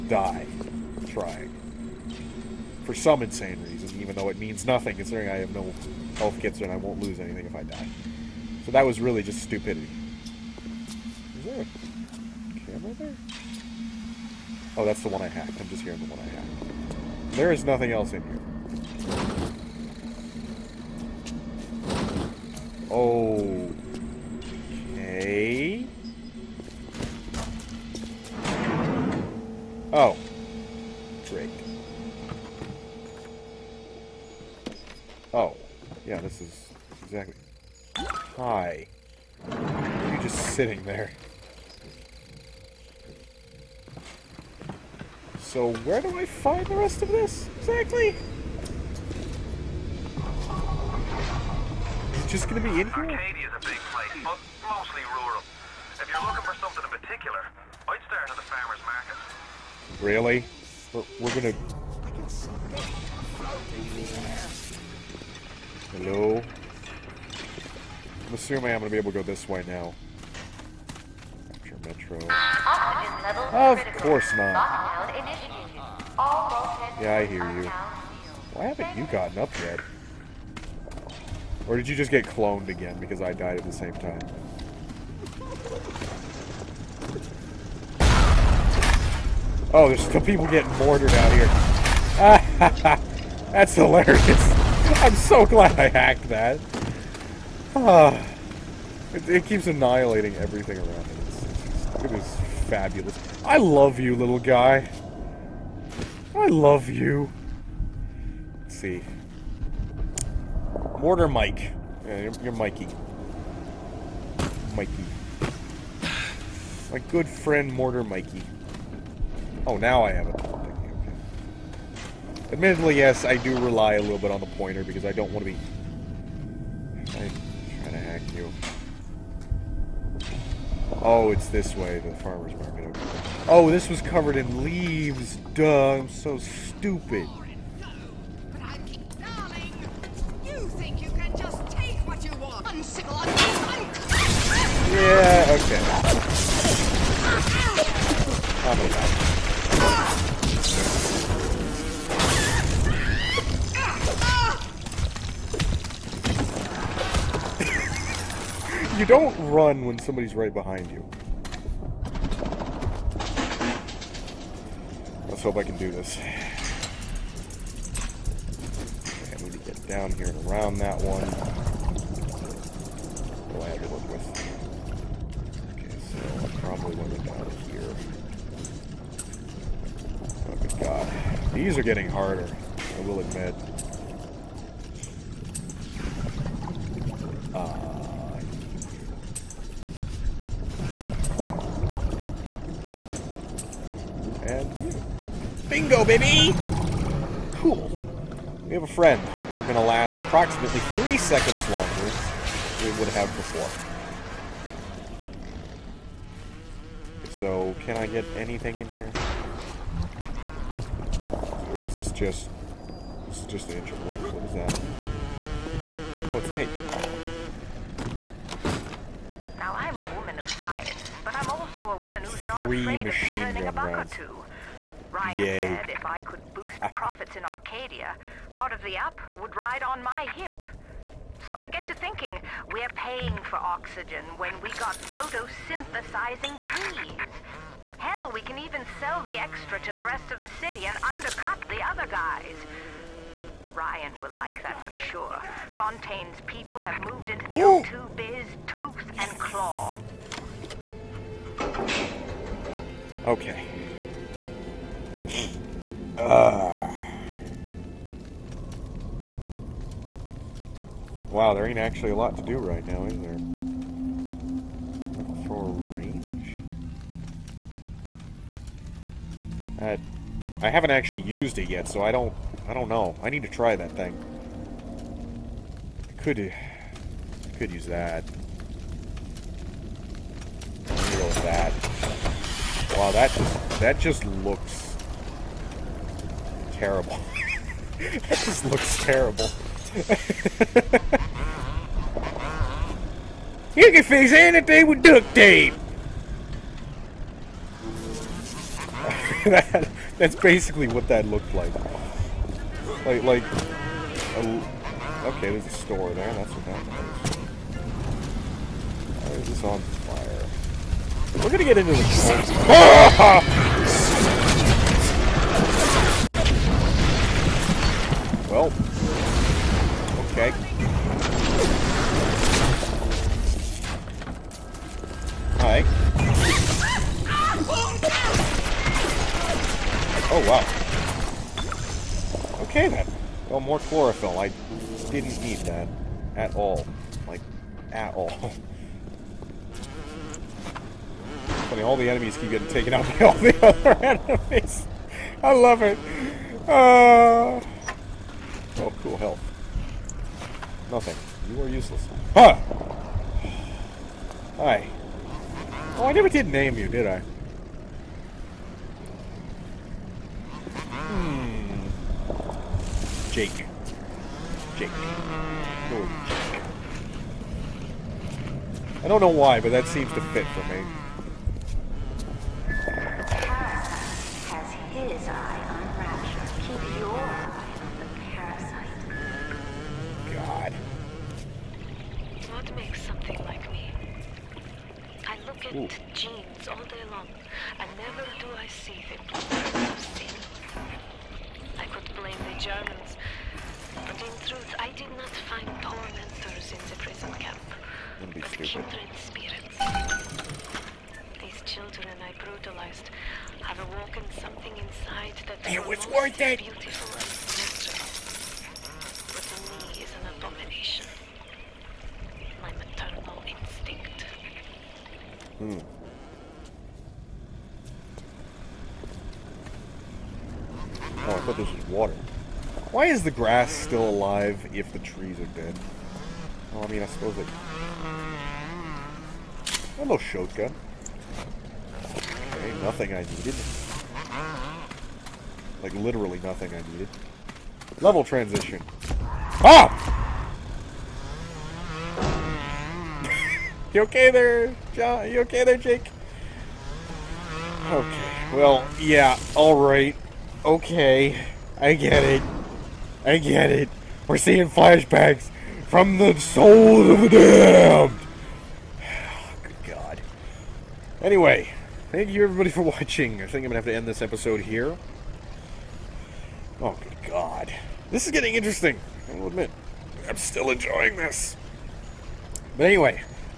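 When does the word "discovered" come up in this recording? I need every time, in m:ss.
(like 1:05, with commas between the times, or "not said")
not said.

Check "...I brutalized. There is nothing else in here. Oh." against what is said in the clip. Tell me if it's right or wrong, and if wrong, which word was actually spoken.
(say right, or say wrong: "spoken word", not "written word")
wrong: "hacked", not "brutalized".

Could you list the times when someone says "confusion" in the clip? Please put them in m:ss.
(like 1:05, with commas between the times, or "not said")
not said.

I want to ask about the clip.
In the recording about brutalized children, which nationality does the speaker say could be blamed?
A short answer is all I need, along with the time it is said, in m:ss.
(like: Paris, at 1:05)
the Germans, at 6:32.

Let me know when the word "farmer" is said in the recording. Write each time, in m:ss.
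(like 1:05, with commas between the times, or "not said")
0:58, 2:12.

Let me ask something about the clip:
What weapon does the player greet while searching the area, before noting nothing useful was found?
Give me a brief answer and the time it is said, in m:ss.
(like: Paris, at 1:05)
shotgun, at 7:10.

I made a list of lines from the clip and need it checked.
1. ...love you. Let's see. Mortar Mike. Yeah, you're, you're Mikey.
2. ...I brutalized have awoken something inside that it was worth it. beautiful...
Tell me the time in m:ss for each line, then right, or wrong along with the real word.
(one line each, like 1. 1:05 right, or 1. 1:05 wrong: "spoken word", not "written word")
1. 1:46 right
2. 6:42 right.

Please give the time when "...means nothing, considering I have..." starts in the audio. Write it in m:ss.
0:04.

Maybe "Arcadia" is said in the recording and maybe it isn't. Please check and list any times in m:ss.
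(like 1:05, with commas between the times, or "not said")
0:52, 3:47.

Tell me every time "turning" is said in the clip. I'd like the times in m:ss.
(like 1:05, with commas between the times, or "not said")
3:43.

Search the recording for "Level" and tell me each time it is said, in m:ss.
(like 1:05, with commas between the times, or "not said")
7:18.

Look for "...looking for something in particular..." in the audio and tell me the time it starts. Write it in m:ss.
0:56.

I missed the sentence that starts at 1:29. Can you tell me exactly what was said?
Oh, there's still people getting mortared out here.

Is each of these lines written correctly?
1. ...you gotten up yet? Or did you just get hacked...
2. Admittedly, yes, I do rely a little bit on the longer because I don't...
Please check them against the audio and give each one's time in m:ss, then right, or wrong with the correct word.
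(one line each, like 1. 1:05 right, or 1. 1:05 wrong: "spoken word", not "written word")
1. 1:18 wrong: "cloned", not "hacked"
2. 2:02 wrong: "pointer", not "longer".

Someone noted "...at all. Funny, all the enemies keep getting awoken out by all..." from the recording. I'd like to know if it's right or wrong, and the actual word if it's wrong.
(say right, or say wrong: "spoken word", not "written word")
wrong: "taken", not "awoken".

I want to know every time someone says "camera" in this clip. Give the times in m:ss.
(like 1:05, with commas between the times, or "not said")
0:12.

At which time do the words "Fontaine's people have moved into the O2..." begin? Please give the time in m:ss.
4:05.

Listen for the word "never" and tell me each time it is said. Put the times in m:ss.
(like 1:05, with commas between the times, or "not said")
5:56, 6:27.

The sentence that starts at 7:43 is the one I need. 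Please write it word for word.
I think I'm gonna have to end this episode here.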